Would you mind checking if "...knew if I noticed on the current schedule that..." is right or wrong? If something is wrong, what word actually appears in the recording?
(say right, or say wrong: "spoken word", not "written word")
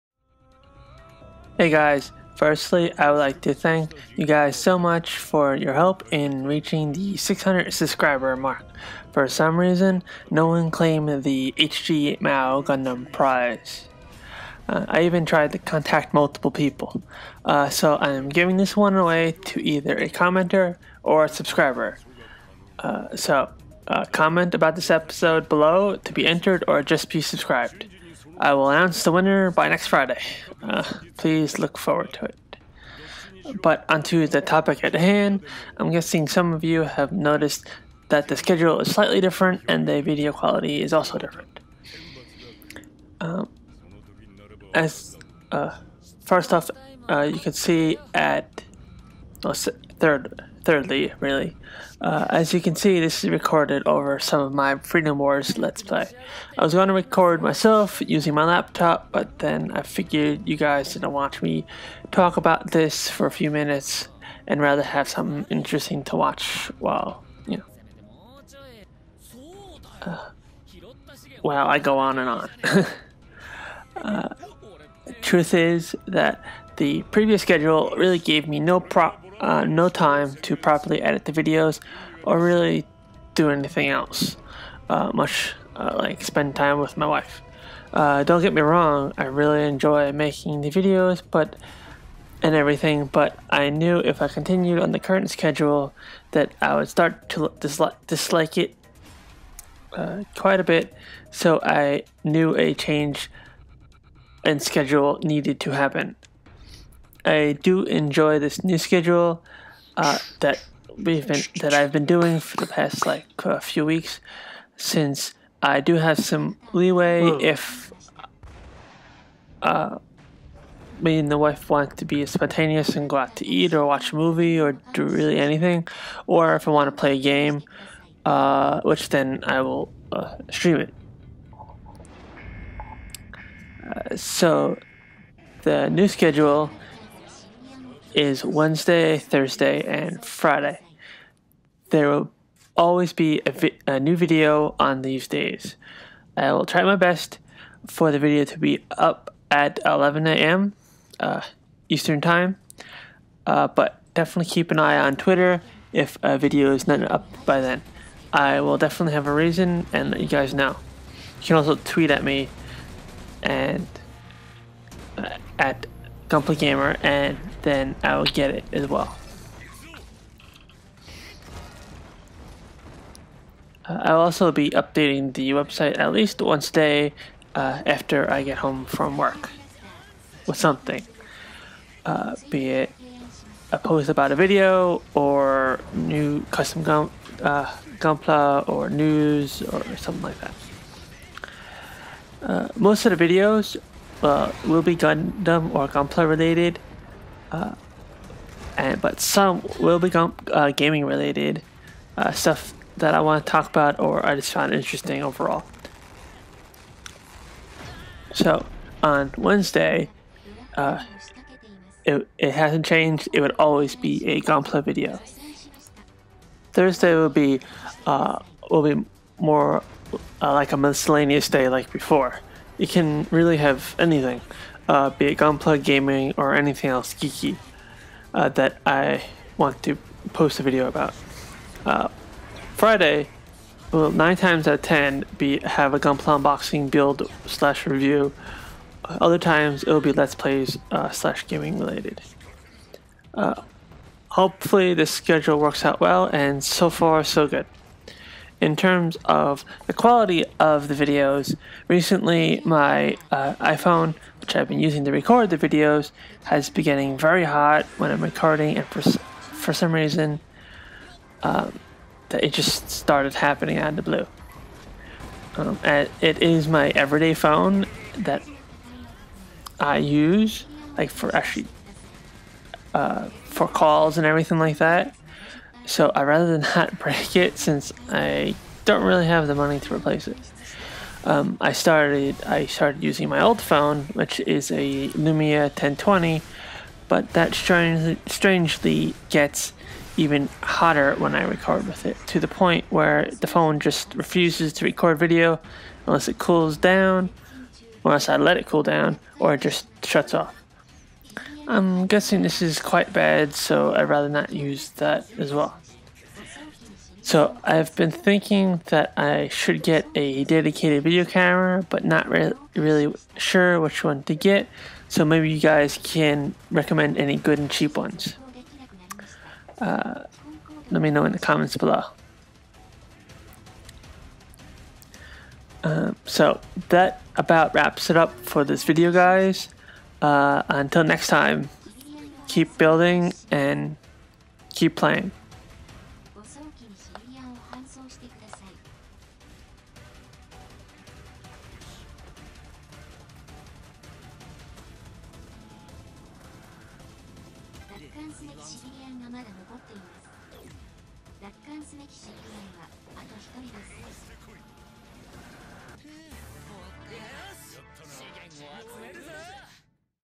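wrong: "continued", not "noticed".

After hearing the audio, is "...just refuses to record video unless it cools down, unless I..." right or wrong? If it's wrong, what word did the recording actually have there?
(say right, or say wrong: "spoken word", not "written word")
right.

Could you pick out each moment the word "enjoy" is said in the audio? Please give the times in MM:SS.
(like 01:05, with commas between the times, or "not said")
01:29, 01:47.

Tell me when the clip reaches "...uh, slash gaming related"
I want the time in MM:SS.
04:00.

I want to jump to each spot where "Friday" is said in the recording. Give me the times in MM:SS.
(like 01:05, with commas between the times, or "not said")
00:29, 02:20, 03:52.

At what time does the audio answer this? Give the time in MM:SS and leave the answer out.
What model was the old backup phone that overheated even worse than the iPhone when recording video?
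04:45.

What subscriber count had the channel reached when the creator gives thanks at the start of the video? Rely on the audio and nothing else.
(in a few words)
600.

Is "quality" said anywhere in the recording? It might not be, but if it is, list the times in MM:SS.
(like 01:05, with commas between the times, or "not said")
00:40, 04:09.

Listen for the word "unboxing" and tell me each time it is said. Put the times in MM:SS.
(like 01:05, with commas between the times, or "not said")
03:56.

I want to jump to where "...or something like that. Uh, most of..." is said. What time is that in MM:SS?
03:09.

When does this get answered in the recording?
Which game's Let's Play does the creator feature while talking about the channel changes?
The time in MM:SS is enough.
00:54.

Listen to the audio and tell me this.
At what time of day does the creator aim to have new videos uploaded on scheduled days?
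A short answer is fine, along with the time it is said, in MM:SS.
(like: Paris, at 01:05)
11 a.m. Eastern Time, at 02:29.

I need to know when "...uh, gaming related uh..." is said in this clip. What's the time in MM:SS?
03:20.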